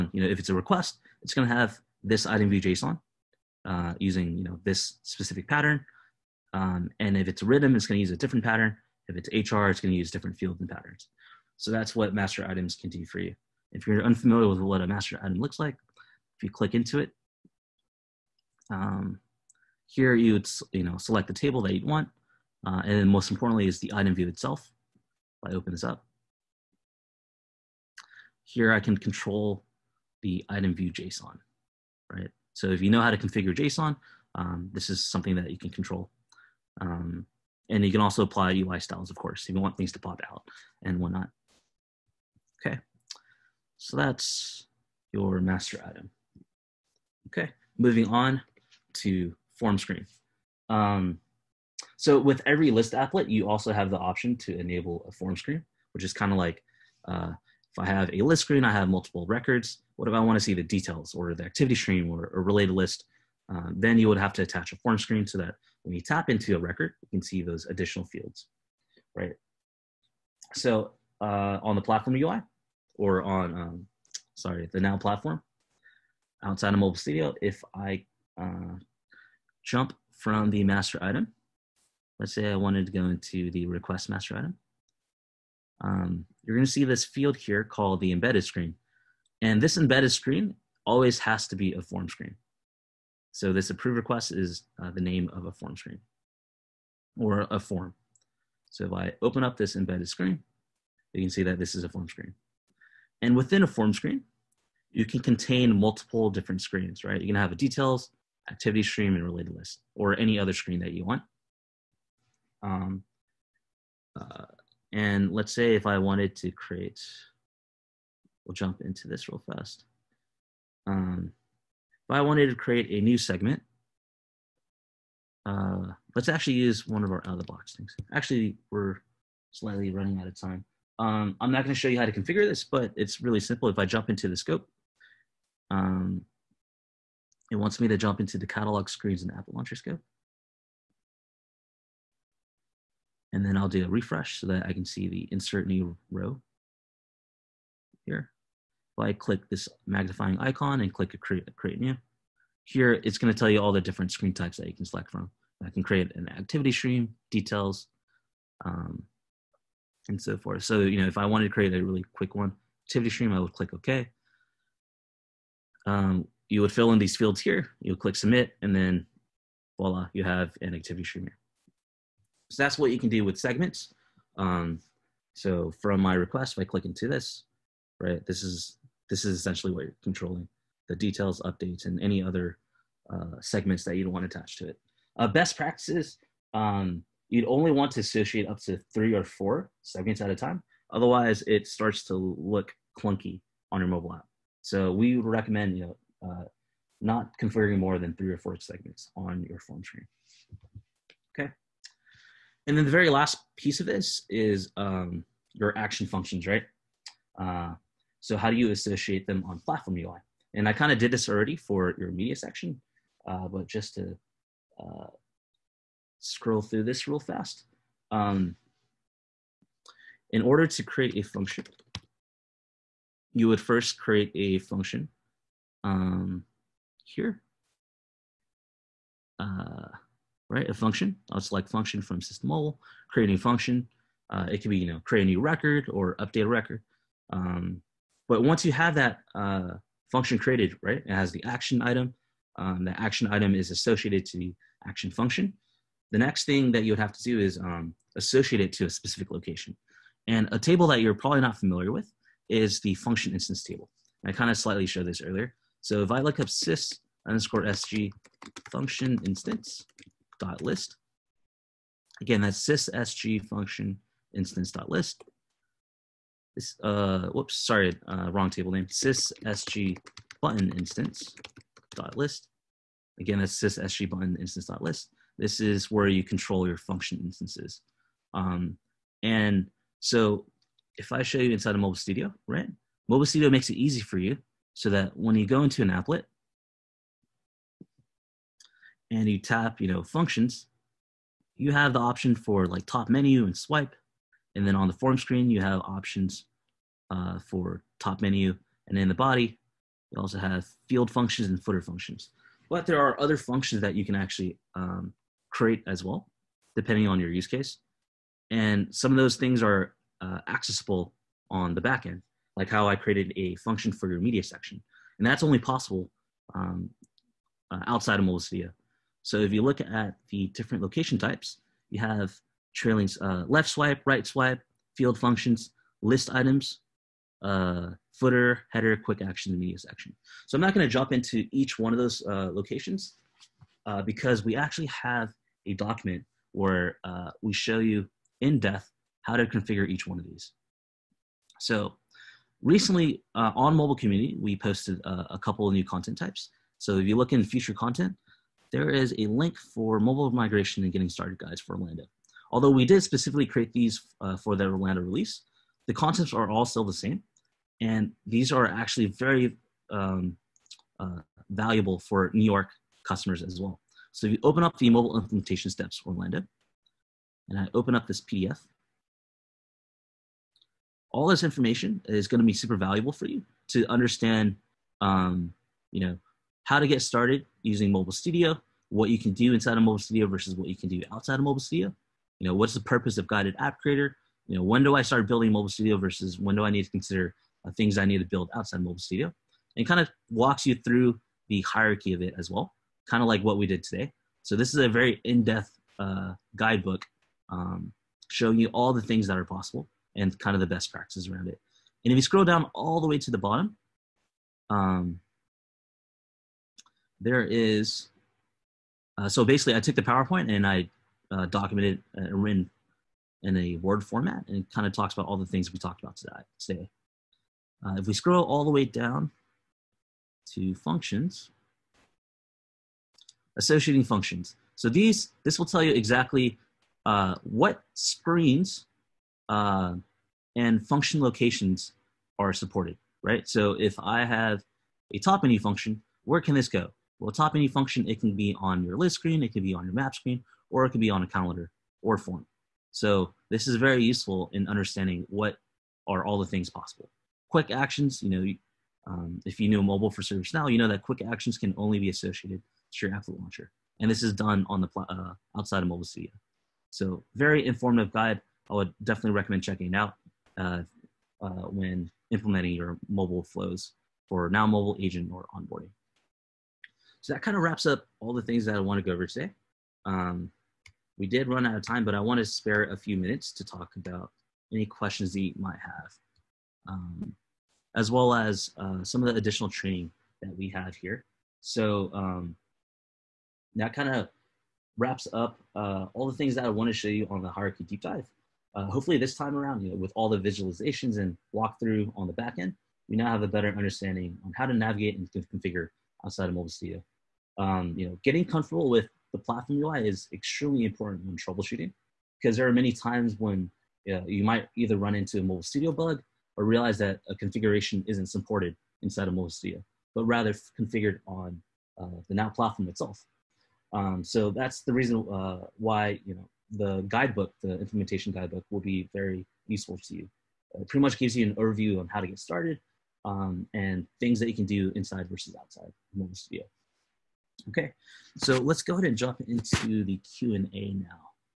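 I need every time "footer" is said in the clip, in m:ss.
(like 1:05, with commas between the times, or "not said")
5:01, 5:28.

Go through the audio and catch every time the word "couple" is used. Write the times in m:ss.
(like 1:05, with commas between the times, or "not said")
5:45.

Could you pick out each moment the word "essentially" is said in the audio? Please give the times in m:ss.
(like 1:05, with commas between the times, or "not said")
2:59.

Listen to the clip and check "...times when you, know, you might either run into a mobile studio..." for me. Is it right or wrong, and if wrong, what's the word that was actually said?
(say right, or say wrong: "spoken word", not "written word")
right.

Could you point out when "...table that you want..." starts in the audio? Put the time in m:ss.
0:21.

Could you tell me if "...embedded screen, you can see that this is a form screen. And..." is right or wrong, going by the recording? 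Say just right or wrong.
right.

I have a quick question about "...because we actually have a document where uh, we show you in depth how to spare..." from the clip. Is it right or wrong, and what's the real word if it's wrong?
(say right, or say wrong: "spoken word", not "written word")
wrong: "configure", not "spare".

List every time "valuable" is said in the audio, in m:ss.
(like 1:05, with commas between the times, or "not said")
6:01, 6:12.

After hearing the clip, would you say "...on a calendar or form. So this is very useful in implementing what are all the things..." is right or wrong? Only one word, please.
wrong.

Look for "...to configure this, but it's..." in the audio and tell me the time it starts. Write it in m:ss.
2:12.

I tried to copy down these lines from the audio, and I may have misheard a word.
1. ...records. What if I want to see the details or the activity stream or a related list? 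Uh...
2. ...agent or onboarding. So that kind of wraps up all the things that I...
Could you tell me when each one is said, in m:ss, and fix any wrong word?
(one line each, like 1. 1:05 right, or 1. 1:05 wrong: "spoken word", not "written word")
1. 0:59 right
2. 7:44 right.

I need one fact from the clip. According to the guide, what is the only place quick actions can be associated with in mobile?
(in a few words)
App launcher.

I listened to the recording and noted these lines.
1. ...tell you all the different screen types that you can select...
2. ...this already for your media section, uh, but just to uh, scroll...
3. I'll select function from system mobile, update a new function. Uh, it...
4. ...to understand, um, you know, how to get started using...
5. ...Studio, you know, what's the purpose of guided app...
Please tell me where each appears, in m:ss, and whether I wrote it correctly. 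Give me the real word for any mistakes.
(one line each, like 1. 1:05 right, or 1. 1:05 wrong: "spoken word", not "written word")
1. 2:33 right
2. 3:31 right
3. 3:51 wrong: "create", not "update"
4. 6:13 right
5. 6:21 right.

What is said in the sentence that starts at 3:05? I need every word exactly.
Uh, best practices, um, you'd only want to associate up to three or four segments at a time.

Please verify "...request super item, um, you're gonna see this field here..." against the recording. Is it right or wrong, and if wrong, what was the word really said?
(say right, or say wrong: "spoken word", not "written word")
wrong: "master", not "super".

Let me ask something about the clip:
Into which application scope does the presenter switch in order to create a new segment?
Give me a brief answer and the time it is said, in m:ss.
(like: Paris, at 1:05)
Applet Launcher Scope, at 2:19.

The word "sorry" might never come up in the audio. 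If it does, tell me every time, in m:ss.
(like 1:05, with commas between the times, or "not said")
1:14, 4:27.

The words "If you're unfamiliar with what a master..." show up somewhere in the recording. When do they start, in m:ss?
0:13.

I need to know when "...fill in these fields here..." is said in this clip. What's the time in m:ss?
2:46.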